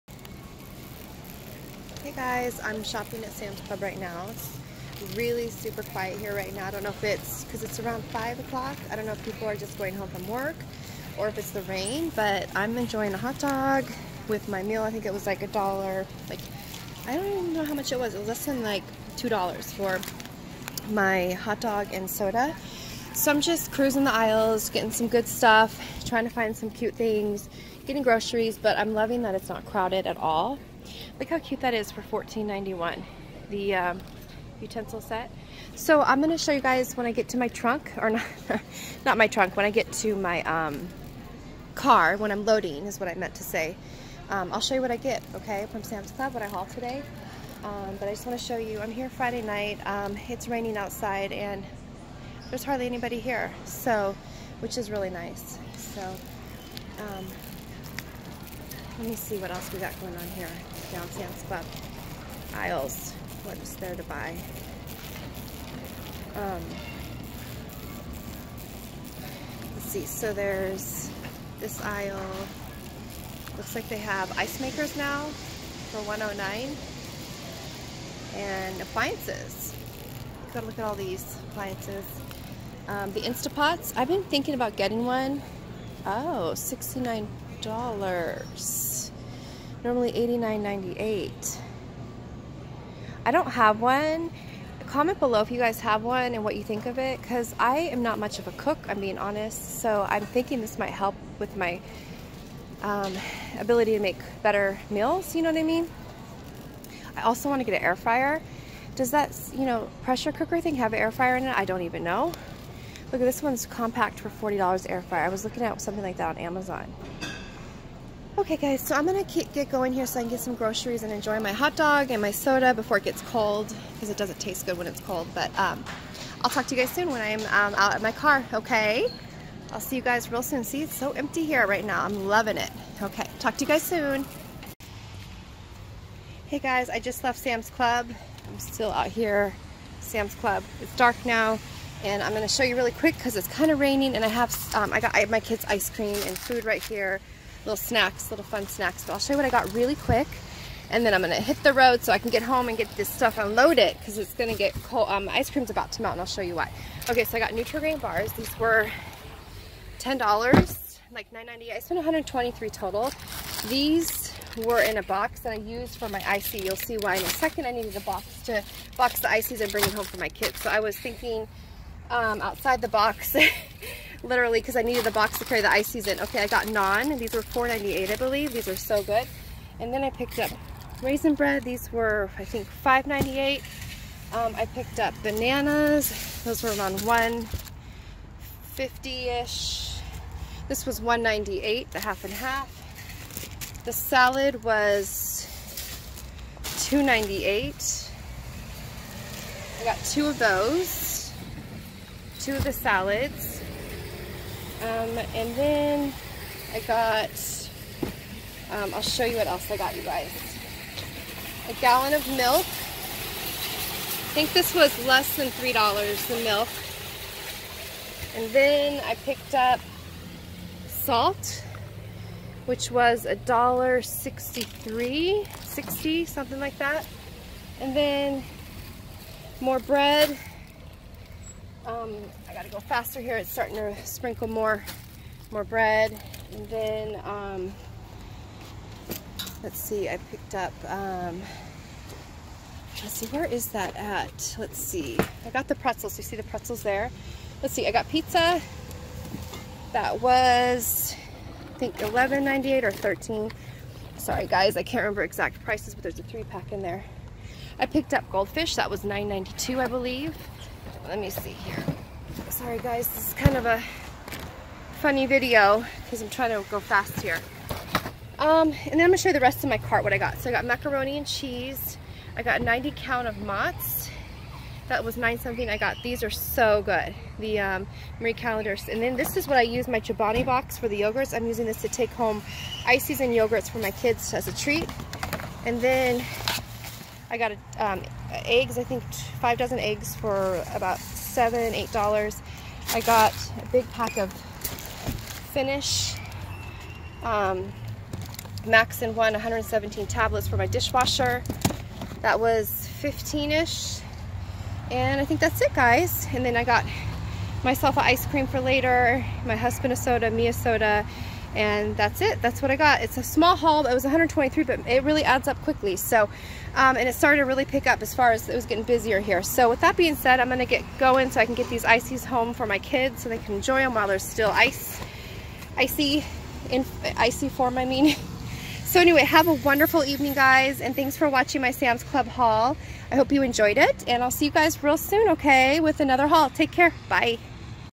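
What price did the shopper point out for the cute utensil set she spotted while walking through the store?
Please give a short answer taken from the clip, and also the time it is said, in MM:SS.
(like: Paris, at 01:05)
$14.91, at 00:32.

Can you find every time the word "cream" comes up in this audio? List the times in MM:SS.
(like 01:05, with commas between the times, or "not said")
02:25, 02:35, 05:08.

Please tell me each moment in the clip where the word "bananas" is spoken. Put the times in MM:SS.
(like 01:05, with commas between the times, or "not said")
03:05.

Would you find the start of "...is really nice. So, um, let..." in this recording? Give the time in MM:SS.
00:54.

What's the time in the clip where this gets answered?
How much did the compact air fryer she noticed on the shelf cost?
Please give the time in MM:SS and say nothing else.
01:54.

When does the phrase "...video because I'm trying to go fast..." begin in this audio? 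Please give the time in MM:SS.
04:25.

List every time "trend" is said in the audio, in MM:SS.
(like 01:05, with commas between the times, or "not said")
not said.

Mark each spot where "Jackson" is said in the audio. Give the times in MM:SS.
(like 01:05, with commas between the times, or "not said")
not said.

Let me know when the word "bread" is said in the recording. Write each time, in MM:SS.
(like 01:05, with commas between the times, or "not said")
03:01, 03:49, 03:55.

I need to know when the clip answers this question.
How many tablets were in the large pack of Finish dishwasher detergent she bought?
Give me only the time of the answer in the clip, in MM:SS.
04:59.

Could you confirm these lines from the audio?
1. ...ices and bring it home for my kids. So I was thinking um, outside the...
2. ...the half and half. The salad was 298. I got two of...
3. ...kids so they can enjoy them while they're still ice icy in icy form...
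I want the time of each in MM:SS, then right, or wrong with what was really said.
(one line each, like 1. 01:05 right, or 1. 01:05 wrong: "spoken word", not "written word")
1. 02:49 right
2. 03:11 right
3. 05:22 right.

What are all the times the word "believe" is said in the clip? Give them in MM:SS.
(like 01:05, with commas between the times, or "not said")
02:58, 04:19.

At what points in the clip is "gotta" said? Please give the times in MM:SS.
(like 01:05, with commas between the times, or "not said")
01:20, 03:52.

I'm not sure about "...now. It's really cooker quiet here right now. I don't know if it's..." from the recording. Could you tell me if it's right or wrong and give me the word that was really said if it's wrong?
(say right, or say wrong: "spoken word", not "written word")
wrong: "super", not "cooker".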